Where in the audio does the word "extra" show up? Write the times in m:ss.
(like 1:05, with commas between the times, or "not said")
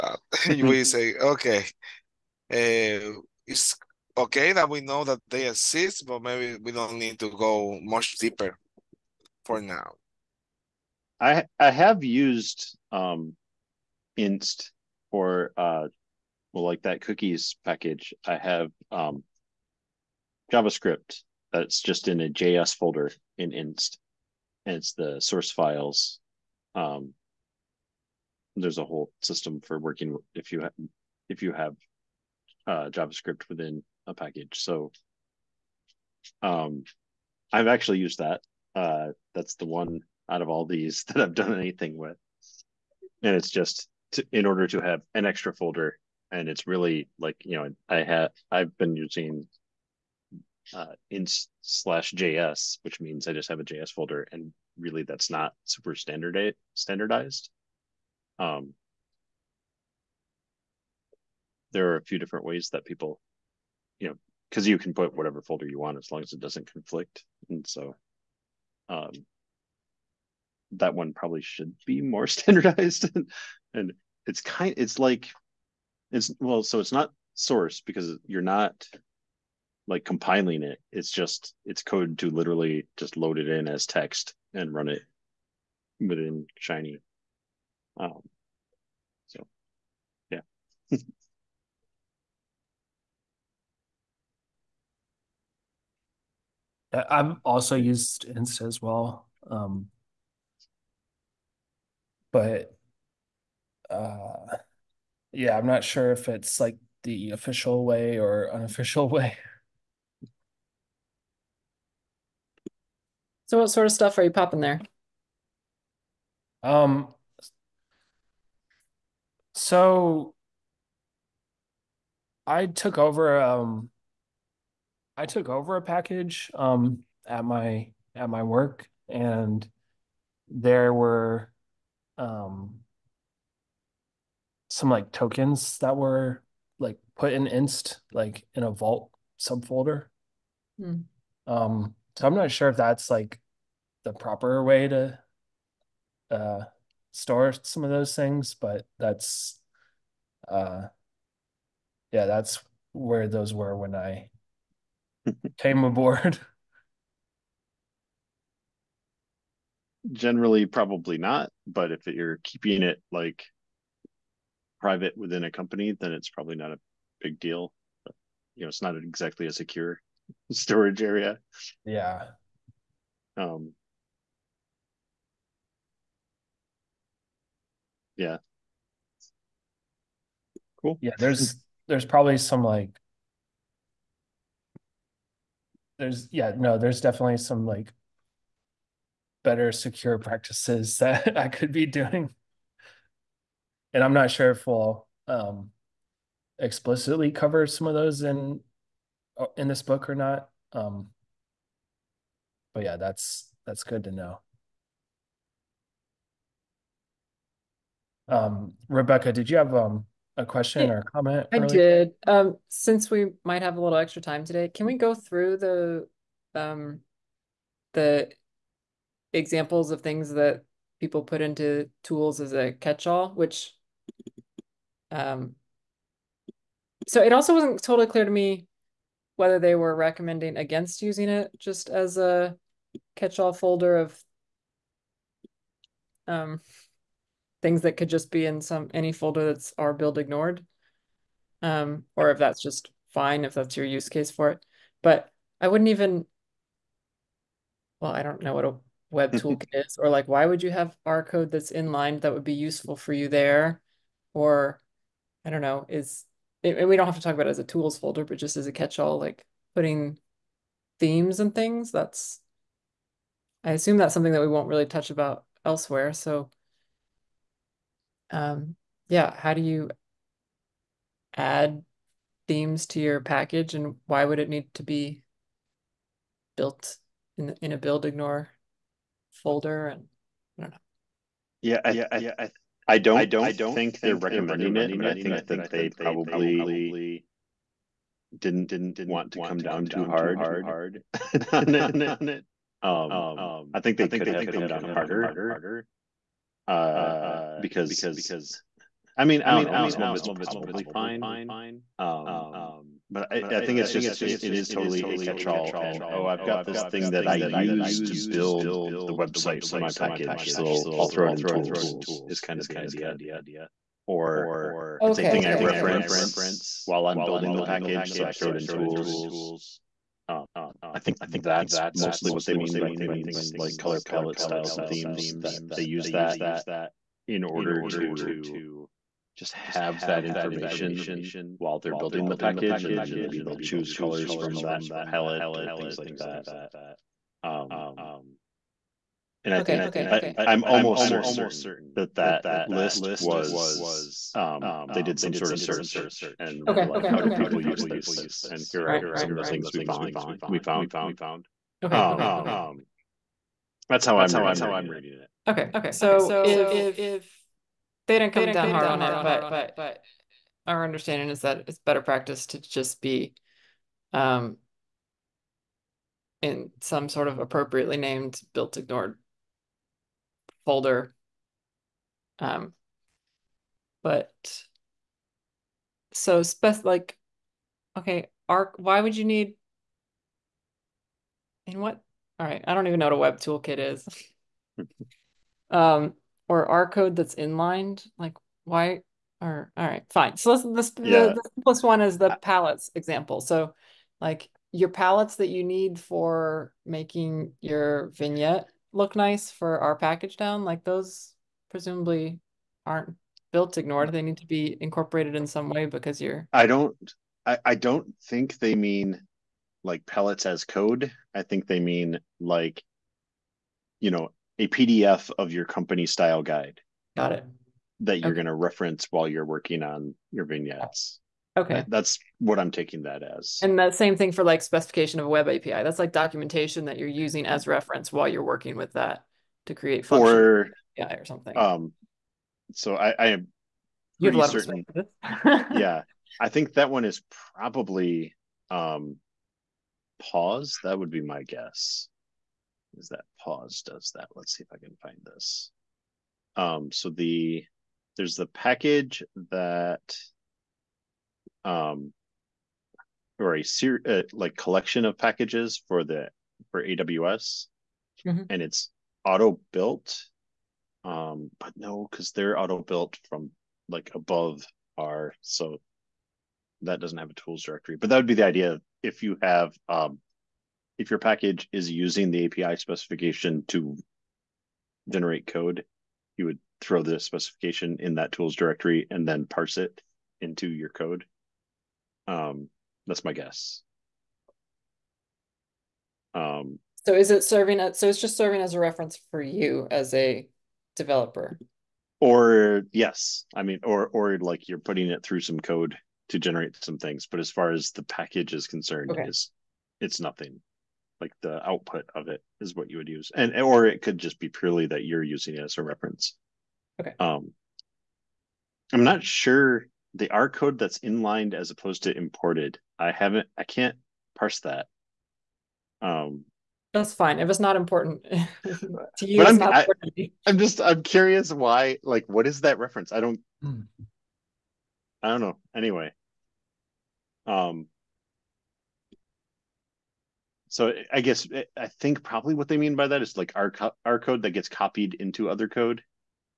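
0:45, 3:33.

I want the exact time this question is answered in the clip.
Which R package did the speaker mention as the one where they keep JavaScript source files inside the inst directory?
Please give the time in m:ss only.
0:17.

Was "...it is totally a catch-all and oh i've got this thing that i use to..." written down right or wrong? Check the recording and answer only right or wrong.
right.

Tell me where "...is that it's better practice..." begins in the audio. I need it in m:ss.
6:01.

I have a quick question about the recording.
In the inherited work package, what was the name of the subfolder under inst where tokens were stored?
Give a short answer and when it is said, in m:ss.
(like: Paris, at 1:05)
vault, at 2:18.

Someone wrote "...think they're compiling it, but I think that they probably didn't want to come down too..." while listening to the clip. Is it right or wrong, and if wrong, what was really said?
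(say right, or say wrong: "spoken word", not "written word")
wrong: "recommending", not "compiling".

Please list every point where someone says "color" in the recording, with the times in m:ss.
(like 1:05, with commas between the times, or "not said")
5:23, 5:33.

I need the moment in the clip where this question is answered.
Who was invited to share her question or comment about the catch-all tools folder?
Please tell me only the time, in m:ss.
3:28.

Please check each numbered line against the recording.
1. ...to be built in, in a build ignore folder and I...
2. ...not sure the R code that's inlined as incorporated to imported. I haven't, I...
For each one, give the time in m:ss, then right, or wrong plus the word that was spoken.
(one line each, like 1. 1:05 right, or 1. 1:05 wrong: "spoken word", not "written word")
1. 4:34 right
2. 8:29 wrong: "opposed", not "incorporated".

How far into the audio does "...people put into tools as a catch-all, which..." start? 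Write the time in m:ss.
3:41.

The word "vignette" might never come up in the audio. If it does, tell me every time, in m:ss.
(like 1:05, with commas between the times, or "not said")
6:38, 7:00.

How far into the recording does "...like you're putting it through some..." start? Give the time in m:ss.
8:14.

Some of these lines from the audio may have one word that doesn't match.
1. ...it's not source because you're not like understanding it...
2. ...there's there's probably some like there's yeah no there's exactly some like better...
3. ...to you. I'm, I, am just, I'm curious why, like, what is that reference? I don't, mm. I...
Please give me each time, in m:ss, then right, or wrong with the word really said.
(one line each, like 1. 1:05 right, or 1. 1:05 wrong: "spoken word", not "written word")
1. 1:16 wrong: "compiling", not "understanding"
2. 3:01 wrong: "definitely", not "exactly"
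3. 8:38 right.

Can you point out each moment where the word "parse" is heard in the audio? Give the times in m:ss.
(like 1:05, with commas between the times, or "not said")
7:59, 8:34.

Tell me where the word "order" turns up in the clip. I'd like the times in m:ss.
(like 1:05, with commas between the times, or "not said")
0:44, 5:27.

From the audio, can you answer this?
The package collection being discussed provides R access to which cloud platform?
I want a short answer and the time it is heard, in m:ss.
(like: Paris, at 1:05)
AWS, at 7:36.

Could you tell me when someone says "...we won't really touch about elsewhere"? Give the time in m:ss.
4:24.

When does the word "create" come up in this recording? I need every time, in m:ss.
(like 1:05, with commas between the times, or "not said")
7:09.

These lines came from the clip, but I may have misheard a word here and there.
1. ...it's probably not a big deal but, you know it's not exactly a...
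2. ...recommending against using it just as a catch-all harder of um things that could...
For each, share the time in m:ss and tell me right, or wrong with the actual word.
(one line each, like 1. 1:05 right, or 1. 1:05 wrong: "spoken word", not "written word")
1. 2:46 right
2. 3:49 wrong: "folder", not "harder".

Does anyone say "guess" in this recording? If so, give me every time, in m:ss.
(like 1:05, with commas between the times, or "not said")
7:21, 8:03, 8:51.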